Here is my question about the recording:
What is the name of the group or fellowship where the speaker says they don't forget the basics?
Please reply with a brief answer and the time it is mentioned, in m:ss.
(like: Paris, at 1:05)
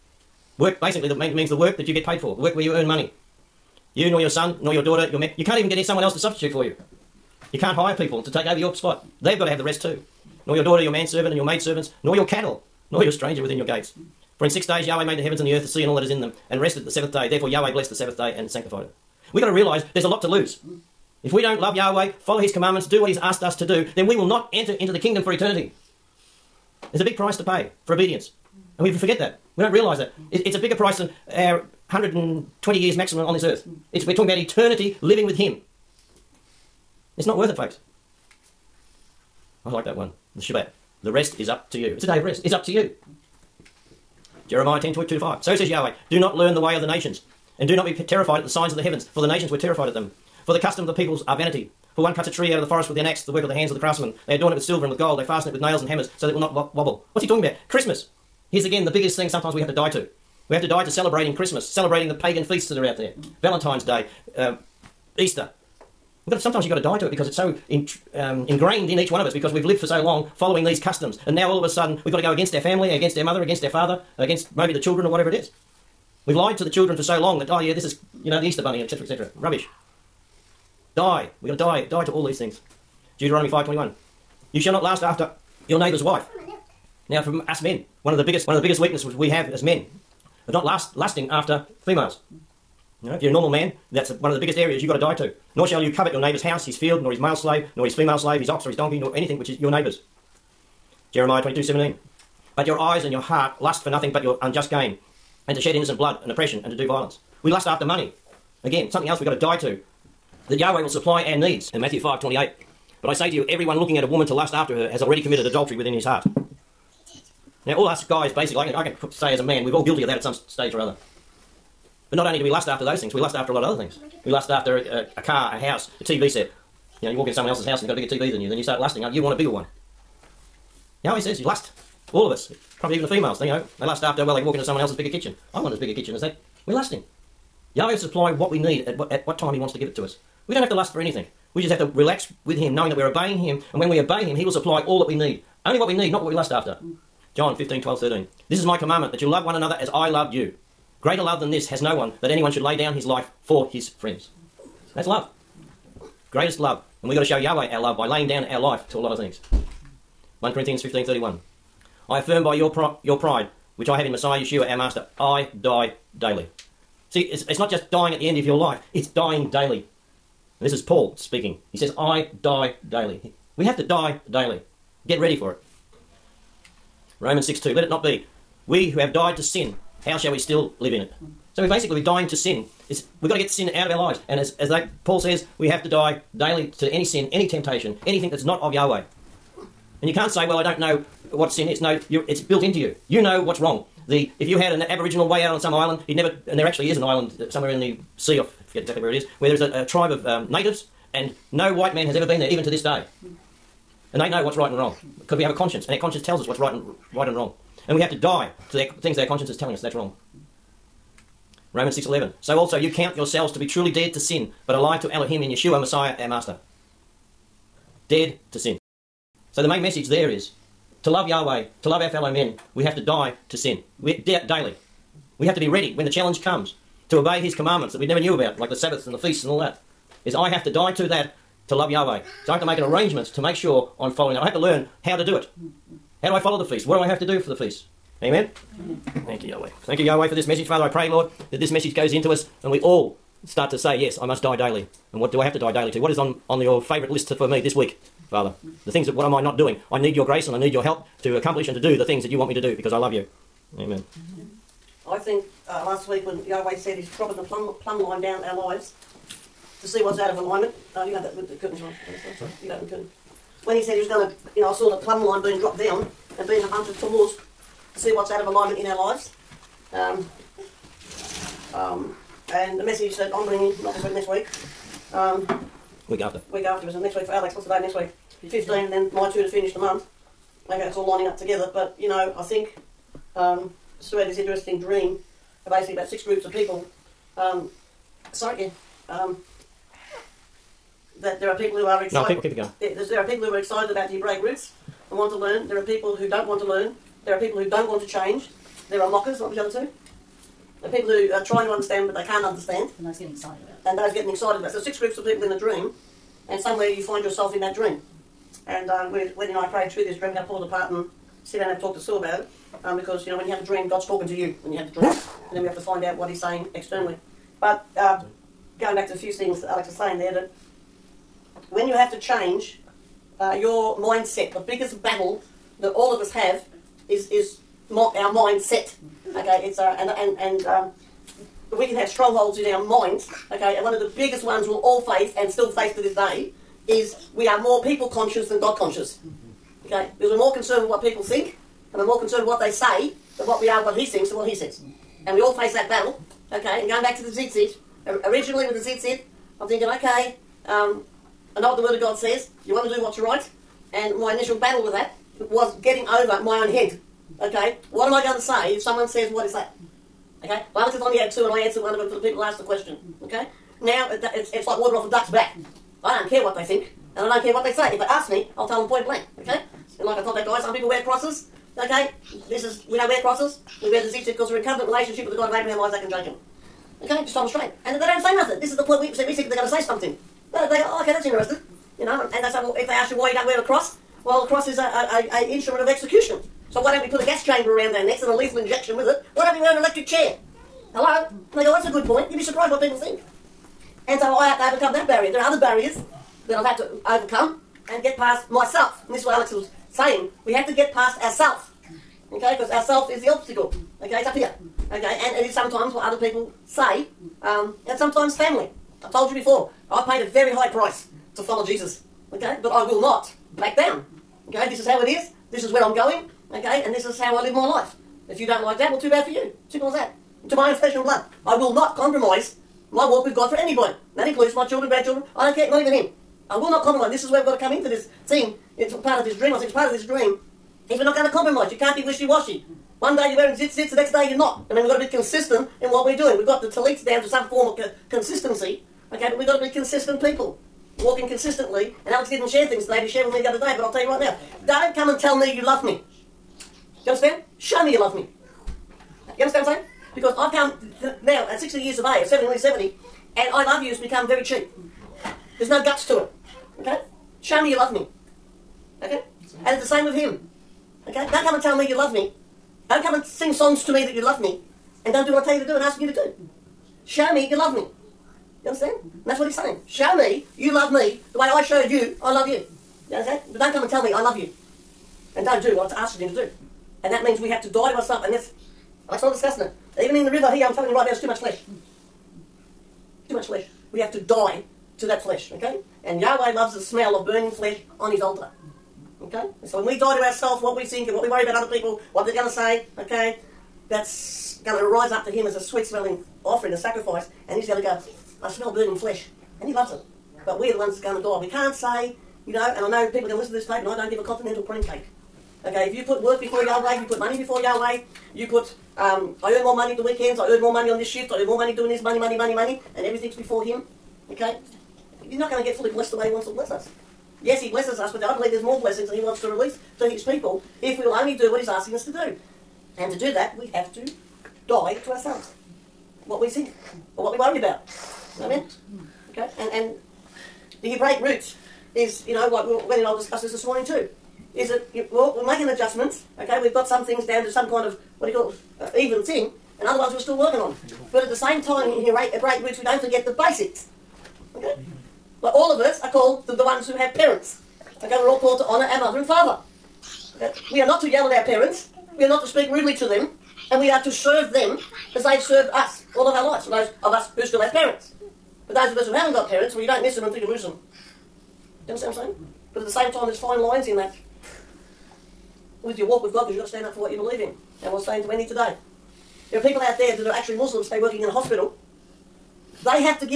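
Break Roots, at 9:02.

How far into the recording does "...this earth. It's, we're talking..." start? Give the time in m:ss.
0:33.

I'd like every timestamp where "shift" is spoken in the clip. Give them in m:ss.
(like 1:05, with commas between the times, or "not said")
8:31.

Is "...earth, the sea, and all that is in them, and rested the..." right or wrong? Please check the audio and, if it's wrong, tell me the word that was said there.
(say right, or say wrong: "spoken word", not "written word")
right.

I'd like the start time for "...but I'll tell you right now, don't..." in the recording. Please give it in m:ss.
7:23.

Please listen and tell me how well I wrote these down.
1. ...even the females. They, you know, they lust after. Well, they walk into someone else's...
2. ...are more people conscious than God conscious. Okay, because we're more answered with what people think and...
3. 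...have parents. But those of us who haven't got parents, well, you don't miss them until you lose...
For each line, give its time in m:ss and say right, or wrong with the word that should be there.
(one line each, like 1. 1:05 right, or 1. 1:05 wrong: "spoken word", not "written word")
1. 2:12 right
2. 5:37 wrong: "concerned", not "answered"
3. 9:17 right.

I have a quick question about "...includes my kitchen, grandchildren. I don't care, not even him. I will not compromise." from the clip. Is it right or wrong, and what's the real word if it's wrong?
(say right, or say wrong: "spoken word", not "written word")
wrong: "children", not "kitchen".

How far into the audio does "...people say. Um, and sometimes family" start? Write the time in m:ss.
6:46.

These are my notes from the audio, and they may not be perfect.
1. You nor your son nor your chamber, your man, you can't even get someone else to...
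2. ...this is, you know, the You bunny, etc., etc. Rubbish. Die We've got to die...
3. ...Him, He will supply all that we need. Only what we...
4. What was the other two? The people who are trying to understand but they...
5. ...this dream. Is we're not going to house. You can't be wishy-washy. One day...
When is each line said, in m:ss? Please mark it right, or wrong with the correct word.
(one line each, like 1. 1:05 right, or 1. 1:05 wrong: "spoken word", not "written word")
1. 0:03 wrong: "daughter", not "chamber"
2. 1:17 wrong: "Easter", not "You"
3. 2:24 right
4. 4:59 right
5. 7:09 wrong: "compromise", not "house".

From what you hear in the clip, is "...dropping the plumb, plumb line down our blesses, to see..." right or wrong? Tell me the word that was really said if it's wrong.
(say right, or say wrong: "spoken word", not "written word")
wrong: "lives", not "blesses".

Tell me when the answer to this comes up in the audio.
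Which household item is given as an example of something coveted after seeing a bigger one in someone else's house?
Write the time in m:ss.
2:06.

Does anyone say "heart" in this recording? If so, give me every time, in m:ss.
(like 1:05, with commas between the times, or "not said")
1:43, 1:56.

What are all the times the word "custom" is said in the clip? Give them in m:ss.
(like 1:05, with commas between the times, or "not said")
0:50, 1:10.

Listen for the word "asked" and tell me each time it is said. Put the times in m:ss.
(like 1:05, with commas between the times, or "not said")
0:23, 6:02, 7:56.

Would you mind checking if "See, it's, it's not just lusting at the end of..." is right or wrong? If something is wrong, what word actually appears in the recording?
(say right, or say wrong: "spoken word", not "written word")
wrong: "dying", not "lusting".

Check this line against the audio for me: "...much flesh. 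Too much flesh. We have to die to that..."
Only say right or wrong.
right.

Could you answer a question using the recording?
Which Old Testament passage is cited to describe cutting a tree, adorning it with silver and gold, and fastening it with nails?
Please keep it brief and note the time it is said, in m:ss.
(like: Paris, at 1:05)
Jeremiah 10:2-5, at 0:44.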